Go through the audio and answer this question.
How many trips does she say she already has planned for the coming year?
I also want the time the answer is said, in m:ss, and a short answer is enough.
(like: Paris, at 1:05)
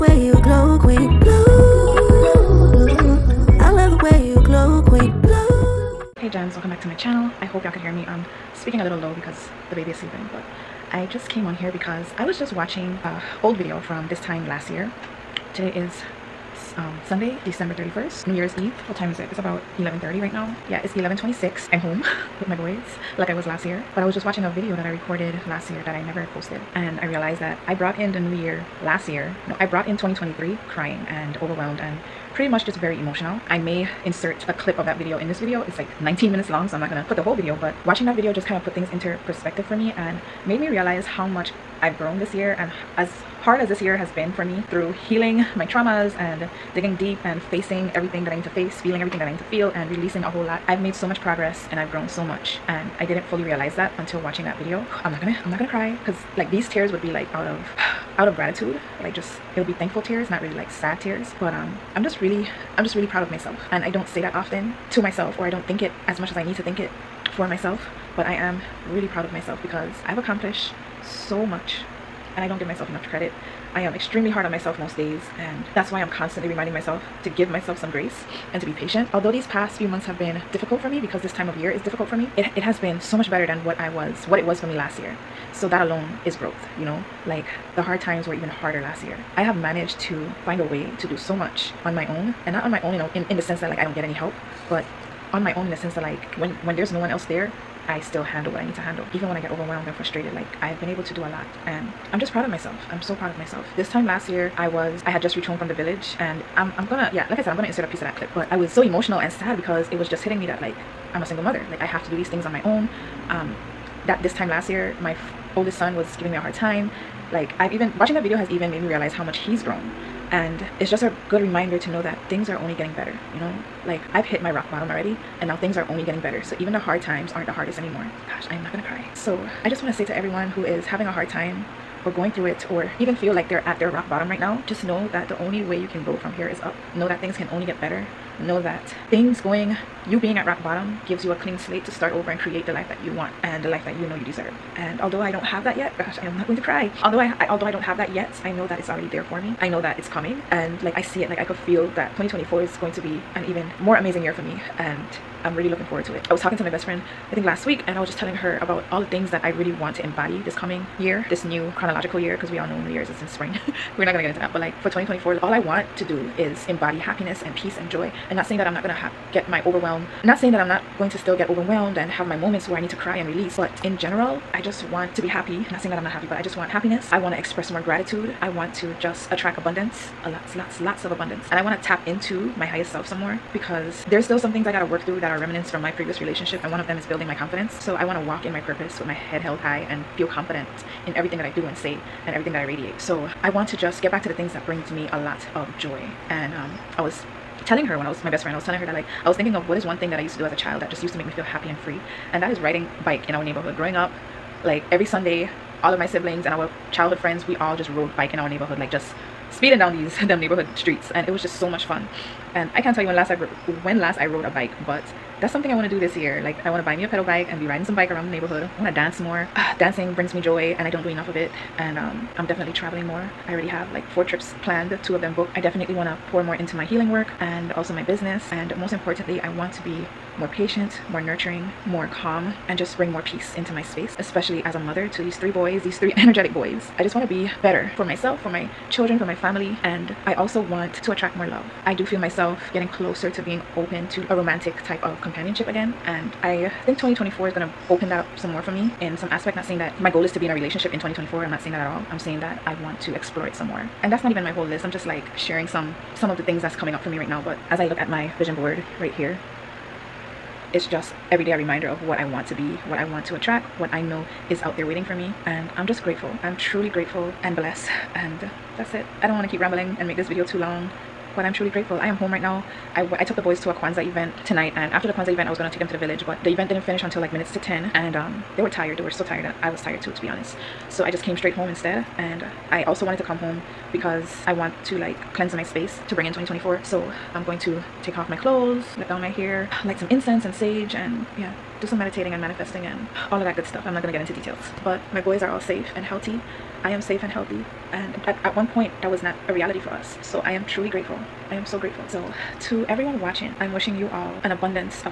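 4, at 3:44.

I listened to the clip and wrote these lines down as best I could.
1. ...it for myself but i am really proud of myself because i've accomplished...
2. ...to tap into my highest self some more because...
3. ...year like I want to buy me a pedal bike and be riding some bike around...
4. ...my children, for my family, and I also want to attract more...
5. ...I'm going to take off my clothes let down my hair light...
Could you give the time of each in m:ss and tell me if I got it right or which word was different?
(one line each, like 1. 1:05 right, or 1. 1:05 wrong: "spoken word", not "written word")
1. 1:06 right
2. 3:01 right
3. 3:36 right
4. 3:58 right
5. 4:47 right.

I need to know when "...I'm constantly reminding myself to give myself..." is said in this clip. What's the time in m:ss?
1:15.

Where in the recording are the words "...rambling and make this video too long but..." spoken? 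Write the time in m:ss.
4:29.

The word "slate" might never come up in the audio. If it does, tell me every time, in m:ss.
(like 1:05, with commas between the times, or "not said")
2:21.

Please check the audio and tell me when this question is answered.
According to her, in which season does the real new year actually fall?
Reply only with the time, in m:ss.
2:43.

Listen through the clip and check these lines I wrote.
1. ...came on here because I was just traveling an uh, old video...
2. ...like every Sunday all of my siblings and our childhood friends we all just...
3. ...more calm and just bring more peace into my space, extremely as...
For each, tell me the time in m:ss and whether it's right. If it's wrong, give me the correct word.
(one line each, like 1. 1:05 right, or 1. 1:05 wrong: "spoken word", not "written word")
1. 0:11 wrong: "watching", not "traveling"
2. 3:24 right
3. 3:51 wrong: "especially", not "extremely".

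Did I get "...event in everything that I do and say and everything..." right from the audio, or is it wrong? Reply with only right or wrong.
wrong.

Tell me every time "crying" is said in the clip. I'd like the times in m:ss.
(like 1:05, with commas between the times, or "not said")
0:30.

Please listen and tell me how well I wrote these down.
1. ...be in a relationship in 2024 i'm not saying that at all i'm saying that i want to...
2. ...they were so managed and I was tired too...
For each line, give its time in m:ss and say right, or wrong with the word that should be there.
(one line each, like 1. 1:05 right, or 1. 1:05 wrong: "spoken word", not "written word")
1. 4:10 right
2. 4:38 wrong: "tired", not "managed".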